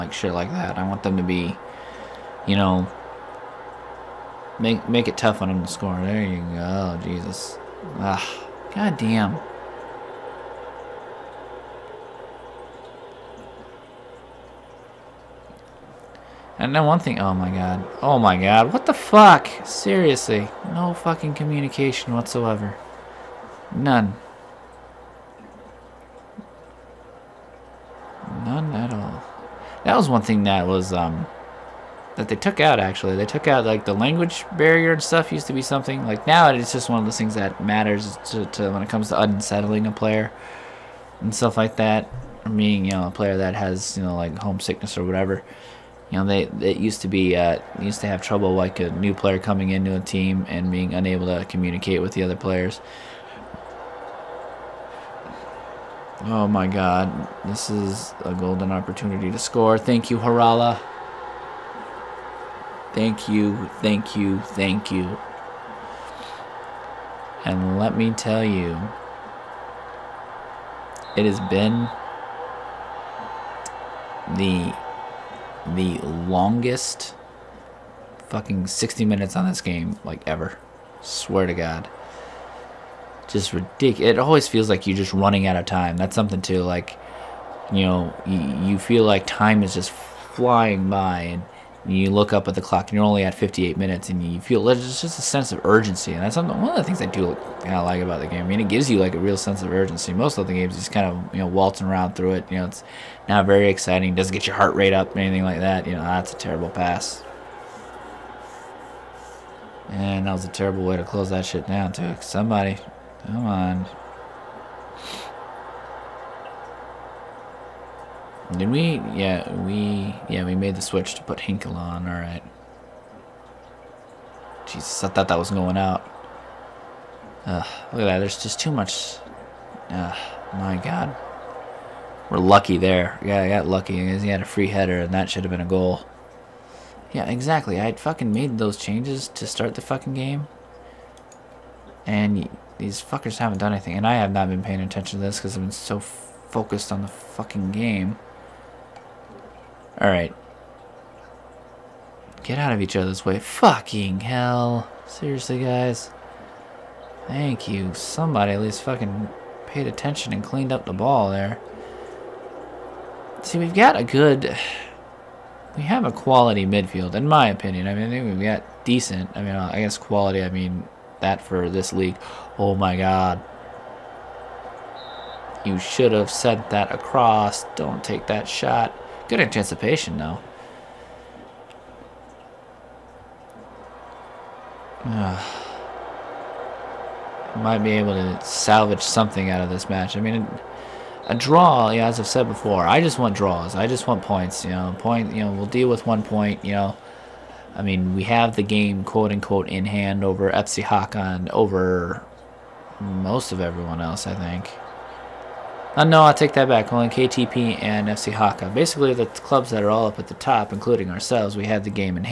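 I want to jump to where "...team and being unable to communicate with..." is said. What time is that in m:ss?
0:49.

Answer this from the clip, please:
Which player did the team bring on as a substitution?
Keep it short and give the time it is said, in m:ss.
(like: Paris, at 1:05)
Hinkle, at 2:01.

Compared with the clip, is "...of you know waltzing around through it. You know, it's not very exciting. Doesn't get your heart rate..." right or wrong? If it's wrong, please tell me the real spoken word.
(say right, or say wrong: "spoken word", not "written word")
right.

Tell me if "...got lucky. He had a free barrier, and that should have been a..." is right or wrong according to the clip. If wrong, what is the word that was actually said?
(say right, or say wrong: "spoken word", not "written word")
wrong: "header", not "barrier".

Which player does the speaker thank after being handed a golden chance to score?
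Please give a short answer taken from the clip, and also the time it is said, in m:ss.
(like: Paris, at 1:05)
Harala, at 1:00.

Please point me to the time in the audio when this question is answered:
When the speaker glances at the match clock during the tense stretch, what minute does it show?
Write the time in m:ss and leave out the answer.
1:33.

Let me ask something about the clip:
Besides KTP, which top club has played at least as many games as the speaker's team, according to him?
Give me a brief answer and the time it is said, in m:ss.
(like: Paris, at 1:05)
FC Haka, at 3:28.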